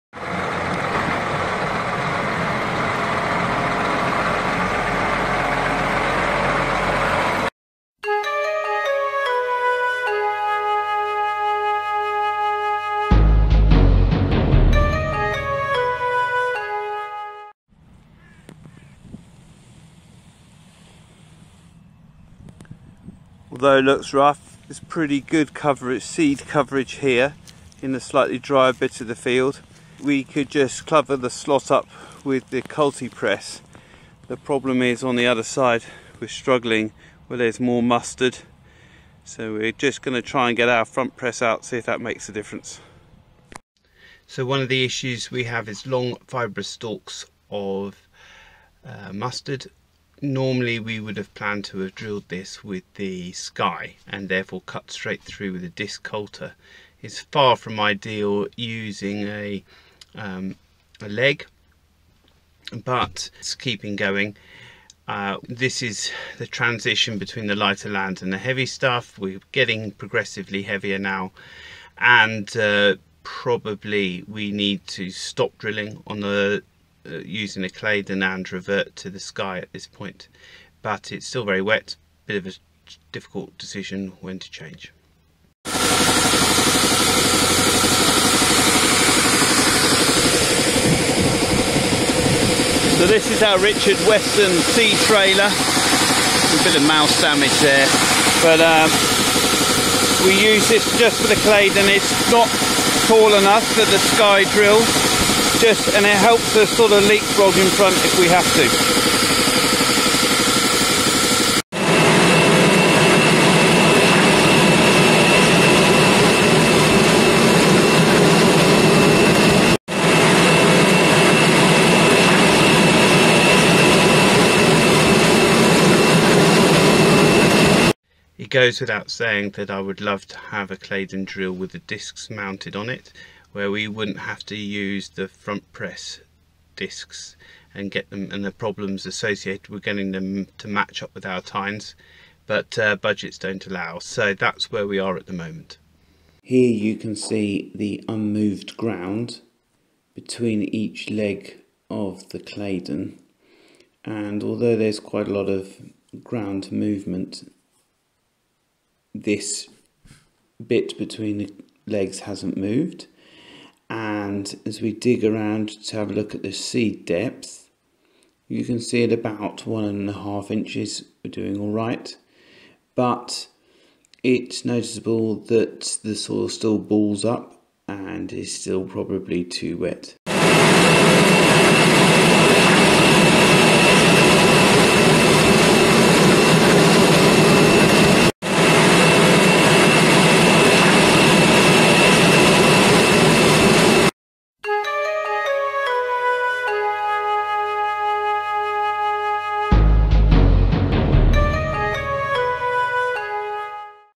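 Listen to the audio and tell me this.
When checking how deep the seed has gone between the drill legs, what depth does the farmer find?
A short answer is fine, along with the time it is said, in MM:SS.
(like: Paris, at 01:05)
1.5 inches, at 02:49.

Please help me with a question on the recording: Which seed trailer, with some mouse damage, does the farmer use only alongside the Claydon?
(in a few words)
Richard Western.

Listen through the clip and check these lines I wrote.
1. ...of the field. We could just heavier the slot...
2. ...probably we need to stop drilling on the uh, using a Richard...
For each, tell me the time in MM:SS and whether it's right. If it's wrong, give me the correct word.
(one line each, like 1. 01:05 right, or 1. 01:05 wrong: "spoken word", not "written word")
1. 00:28 wrong: "cover", not "heavier"
2. 01:13 wrong: "Claydon", not "Richard".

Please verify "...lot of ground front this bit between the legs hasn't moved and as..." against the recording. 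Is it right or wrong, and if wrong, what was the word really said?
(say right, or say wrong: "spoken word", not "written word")
wrong: "movement", not "front".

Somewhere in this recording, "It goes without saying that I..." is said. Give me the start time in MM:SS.
02:08.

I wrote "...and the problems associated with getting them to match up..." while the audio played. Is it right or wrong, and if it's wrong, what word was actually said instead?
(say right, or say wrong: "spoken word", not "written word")
right.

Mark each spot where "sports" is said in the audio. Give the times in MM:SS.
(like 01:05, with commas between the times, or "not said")
not said.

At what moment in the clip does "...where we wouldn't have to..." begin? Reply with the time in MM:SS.
02:13.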